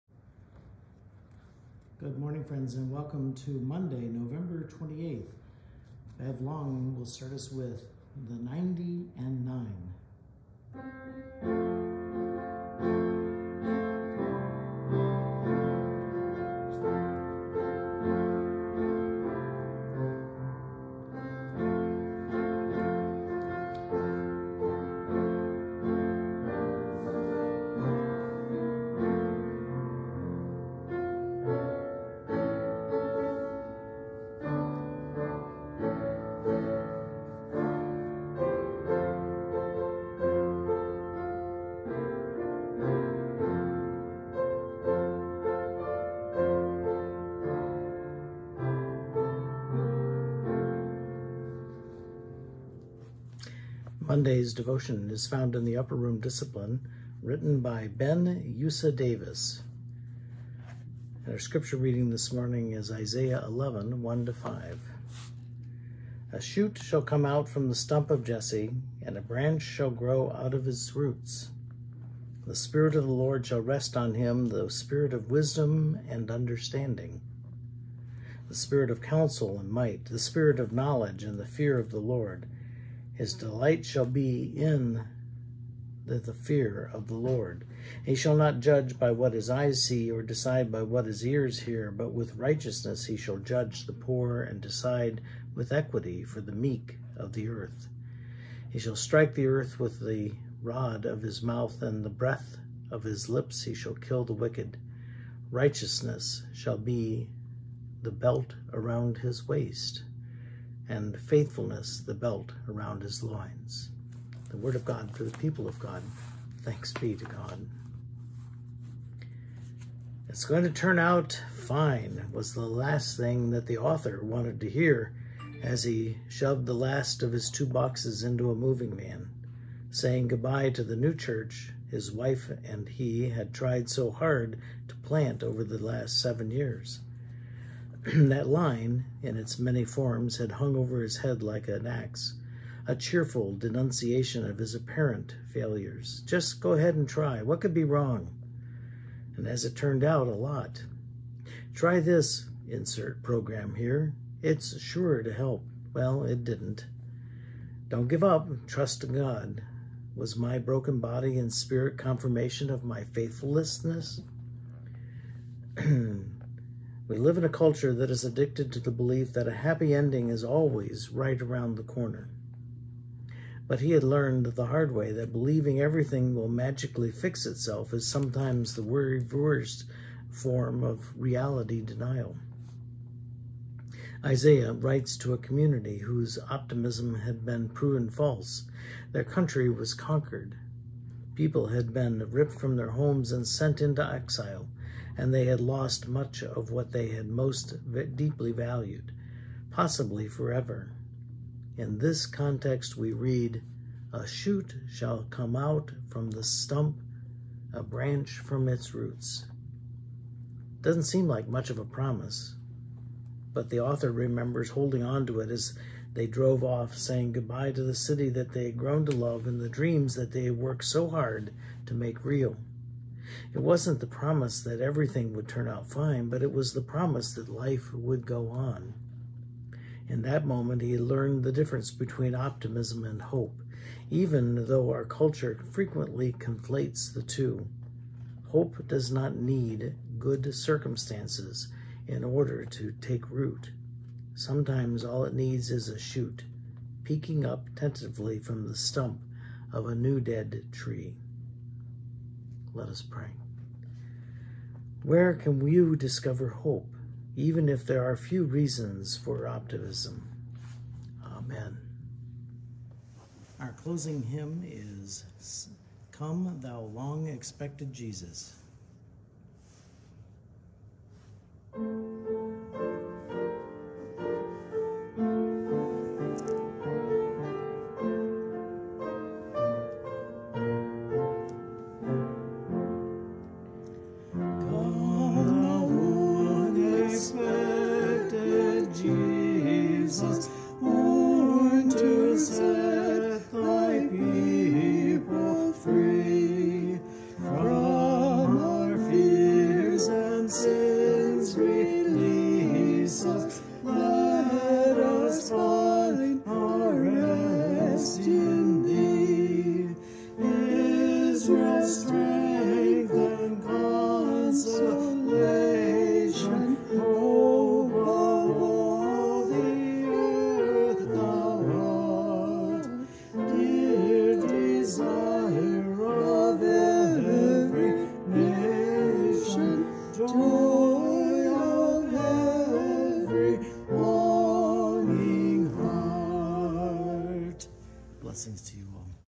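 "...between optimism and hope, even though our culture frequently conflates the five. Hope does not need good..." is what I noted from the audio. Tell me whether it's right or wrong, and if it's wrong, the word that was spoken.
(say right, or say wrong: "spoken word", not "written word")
wrong: "two", not "five".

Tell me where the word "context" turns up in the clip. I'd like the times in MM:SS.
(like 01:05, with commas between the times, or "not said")
03:22.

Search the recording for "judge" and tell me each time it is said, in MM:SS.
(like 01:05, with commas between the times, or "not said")
01:28, 01:33.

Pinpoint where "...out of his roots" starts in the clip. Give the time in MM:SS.
01:10.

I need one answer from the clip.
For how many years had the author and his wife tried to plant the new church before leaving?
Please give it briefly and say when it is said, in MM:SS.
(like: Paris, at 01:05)
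7, at 02:16.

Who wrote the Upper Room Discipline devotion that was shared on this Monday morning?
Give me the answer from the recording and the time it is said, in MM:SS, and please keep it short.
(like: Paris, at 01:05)
Ben Yusa Davis, at 00:57.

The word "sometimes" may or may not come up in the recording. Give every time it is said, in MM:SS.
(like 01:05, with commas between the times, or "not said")
02:58, 04:04.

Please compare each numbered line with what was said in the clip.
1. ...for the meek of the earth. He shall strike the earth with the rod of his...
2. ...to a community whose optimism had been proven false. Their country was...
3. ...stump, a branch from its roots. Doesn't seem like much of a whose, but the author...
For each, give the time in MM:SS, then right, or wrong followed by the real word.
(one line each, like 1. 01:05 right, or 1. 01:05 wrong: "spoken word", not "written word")
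1. 01:36 right
2. 03:05 right
3. 03:26 wrong: "promise", not "whose".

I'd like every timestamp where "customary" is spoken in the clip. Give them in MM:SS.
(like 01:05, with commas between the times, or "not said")
not said.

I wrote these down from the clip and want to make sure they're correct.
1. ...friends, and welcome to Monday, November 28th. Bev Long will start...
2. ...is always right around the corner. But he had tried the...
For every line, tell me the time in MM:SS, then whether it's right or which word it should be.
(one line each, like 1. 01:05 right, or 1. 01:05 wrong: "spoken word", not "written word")
1. 00:02 right
2. 02:50 wrong: "learned", not "tried".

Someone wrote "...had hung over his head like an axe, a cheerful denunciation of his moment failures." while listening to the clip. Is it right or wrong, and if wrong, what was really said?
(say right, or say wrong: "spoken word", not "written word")
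wrong: "apparent", not "moment".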